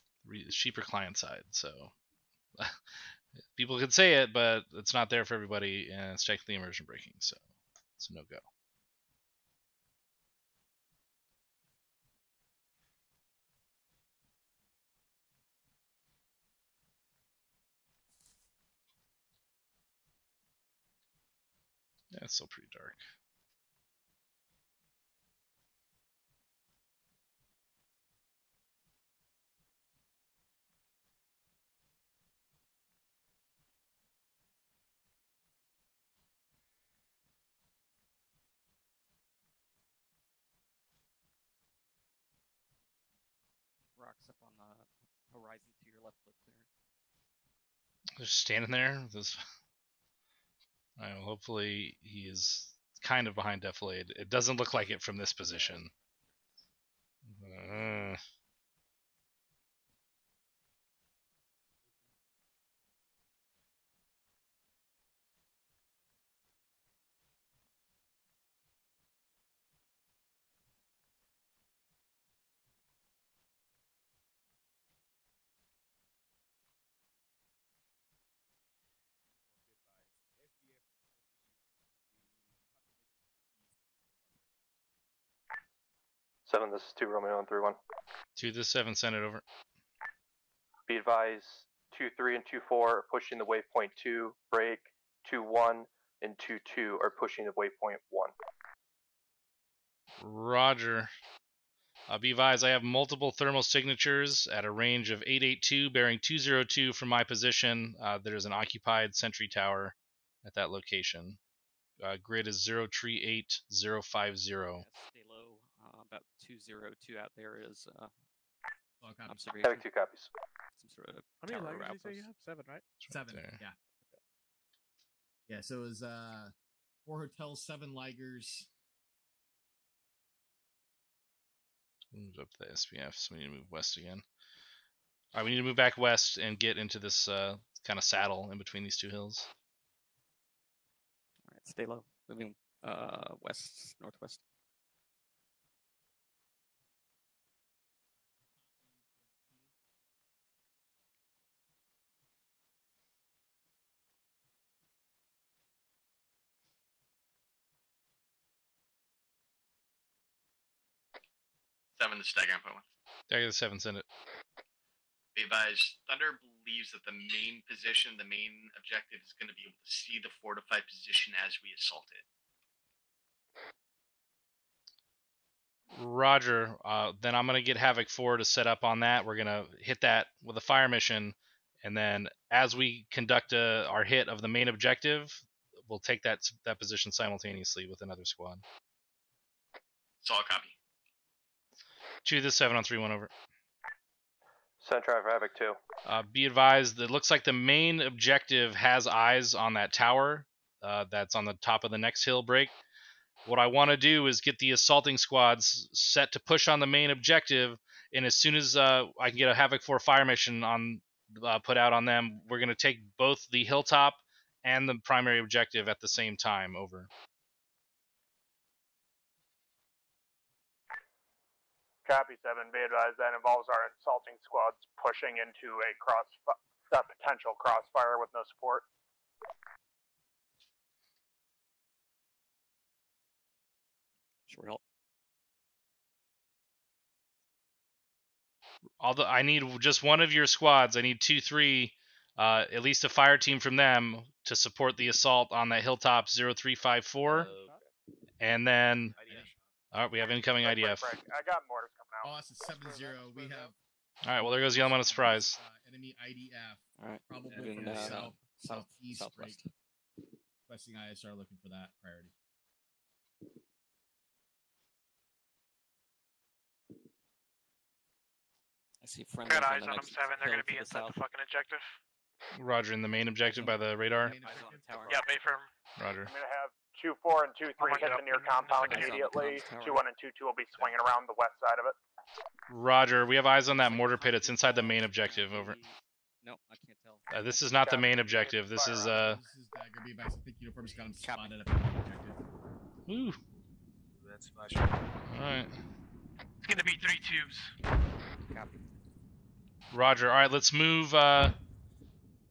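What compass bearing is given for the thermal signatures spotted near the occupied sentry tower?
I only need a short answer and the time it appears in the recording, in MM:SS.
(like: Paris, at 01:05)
202, at 01:45.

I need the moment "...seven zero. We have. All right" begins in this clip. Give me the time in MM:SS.
04:12.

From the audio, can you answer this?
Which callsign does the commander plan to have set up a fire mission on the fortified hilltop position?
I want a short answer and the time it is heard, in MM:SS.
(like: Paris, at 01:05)
Havoc Four, at 02:57.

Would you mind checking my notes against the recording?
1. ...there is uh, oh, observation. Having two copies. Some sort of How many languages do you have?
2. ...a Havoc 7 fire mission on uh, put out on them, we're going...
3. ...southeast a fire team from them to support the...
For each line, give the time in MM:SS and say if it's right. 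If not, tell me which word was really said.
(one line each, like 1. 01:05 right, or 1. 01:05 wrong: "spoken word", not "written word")
1. 01:57 right
2. 03:29 wrong: "4", not "7"
3. 04:02 wrong: "least", not "southeast".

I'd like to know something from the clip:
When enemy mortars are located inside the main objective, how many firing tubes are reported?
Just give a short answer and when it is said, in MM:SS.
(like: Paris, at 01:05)
3, at 04:57.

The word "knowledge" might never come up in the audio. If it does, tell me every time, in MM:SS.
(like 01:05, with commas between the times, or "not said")
not said.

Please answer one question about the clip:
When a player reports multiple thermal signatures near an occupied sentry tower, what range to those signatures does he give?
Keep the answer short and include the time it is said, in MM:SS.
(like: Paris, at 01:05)
882, at 01:45.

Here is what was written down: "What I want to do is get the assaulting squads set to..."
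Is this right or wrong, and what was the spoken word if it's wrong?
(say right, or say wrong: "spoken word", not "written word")
right.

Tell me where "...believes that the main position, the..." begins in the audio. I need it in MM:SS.
02:46.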